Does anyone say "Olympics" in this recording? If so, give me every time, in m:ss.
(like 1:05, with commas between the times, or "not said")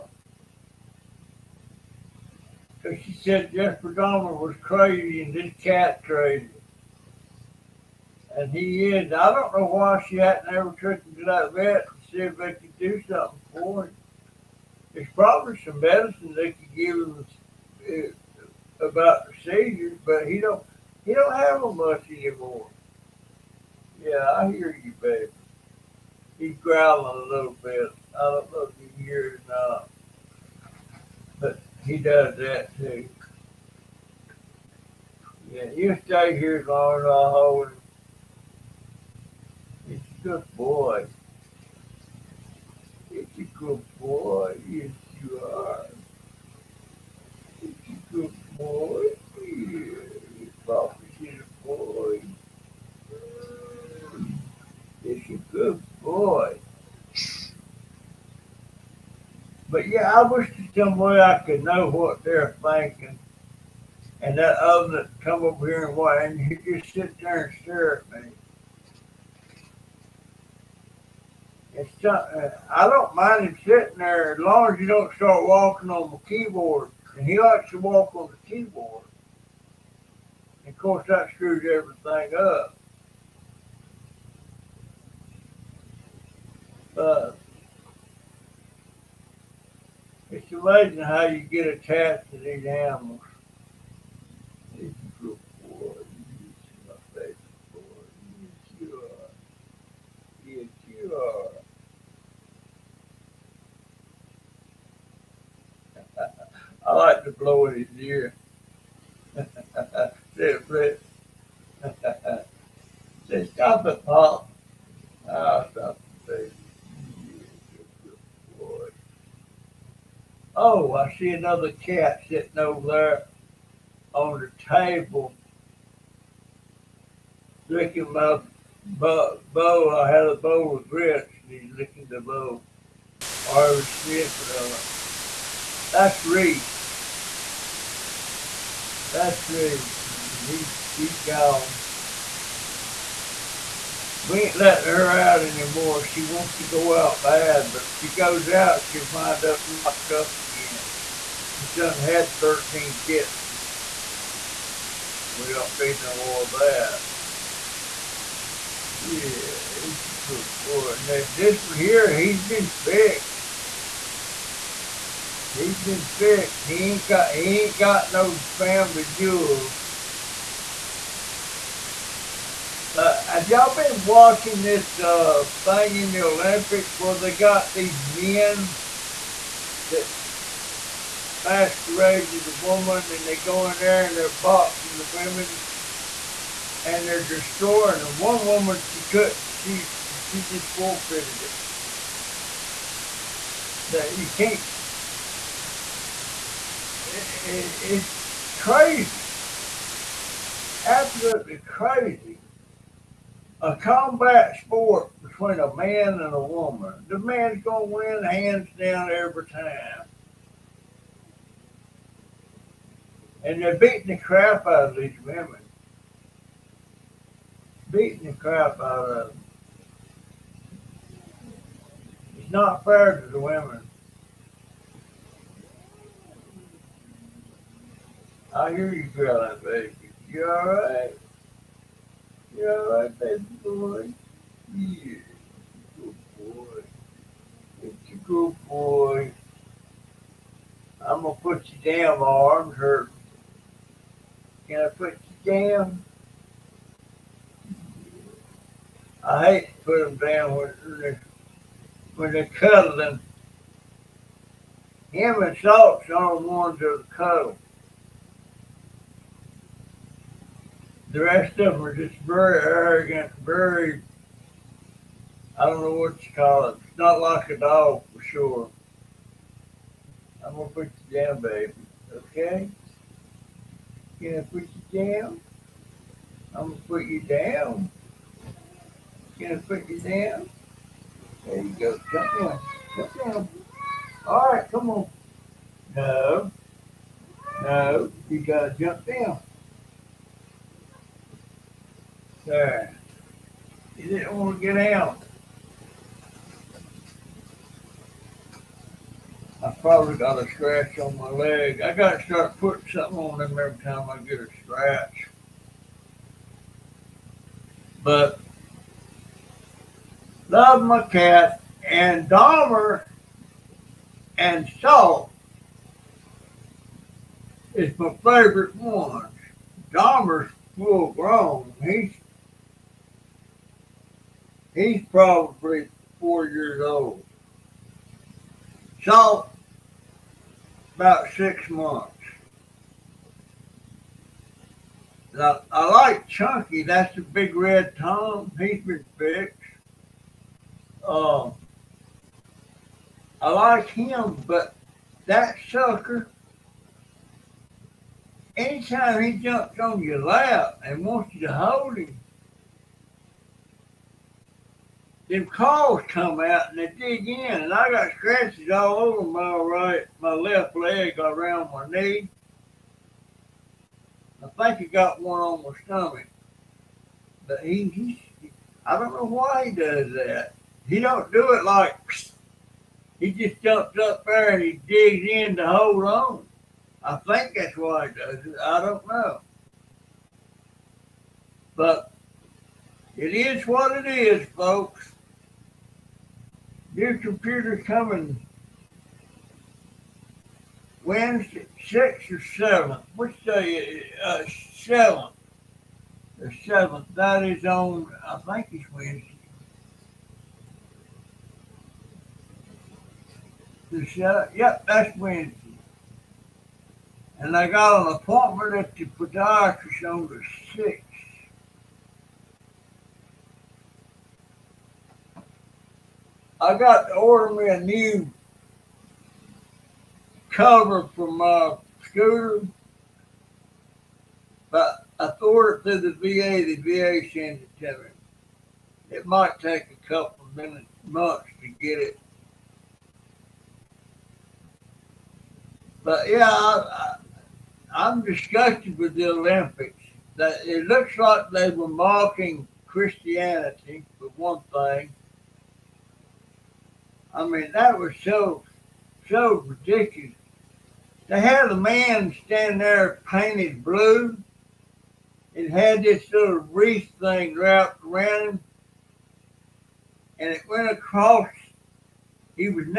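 2:56, 7:19.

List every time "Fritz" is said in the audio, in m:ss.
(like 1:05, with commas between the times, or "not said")
1:50.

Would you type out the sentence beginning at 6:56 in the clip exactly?
I got to order me a new cover for my scooter.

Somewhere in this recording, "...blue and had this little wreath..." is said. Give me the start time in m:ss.
7:33.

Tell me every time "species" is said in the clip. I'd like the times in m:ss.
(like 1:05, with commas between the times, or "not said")
not said.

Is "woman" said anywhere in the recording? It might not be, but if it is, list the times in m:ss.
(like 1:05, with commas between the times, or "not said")
3:02, 3:08, 3:26.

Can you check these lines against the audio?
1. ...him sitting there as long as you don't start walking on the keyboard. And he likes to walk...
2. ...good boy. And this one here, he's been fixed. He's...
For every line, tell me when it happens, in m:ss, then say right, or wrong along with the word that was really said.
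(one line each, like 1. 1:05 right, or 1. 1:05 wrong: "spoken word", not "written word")
1. 1:13 right
2. 2:40 right.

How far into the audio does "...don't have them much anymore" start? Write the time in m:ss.
0:21.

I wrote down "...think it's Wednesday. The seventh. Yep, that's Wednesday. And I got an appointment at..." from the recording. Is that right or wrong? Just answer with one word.
right.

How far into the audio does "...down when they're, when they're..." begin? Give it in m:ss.
4:10.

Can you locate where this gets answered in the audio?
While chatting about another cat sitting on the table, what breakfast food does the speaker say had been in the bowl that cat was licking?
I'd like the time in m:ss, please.
2:10.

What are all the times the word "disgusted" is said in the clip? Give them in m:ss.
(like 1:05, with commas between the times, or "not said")
7:18.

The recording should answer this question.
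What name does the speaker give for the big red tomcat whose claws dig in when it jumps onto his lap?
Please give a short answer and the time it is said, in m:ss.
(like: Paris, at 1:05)
Chunky, at 5:36.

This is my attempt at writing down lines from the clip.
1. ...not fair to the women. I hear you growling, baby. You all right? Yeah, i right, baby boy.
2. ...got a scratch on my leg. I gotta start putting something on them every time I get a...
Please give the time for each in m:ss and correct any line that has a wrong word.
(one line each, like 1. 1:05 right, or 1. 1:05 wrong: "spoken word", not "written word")
1. 3:42 right
2. 5:00 right.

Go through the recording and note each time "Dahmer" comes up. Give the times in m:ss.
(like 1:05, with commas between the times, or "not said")
0:03, 5:12, 5:19.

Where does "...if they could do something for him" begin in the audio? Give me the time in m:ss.
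0:12.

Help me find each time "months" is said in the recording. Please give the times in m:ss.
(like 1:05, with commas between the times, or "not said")
5:31, 7:11.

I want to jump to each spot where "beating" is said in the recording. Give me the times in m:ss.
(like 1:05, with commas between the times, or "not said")
3:33, 3:37.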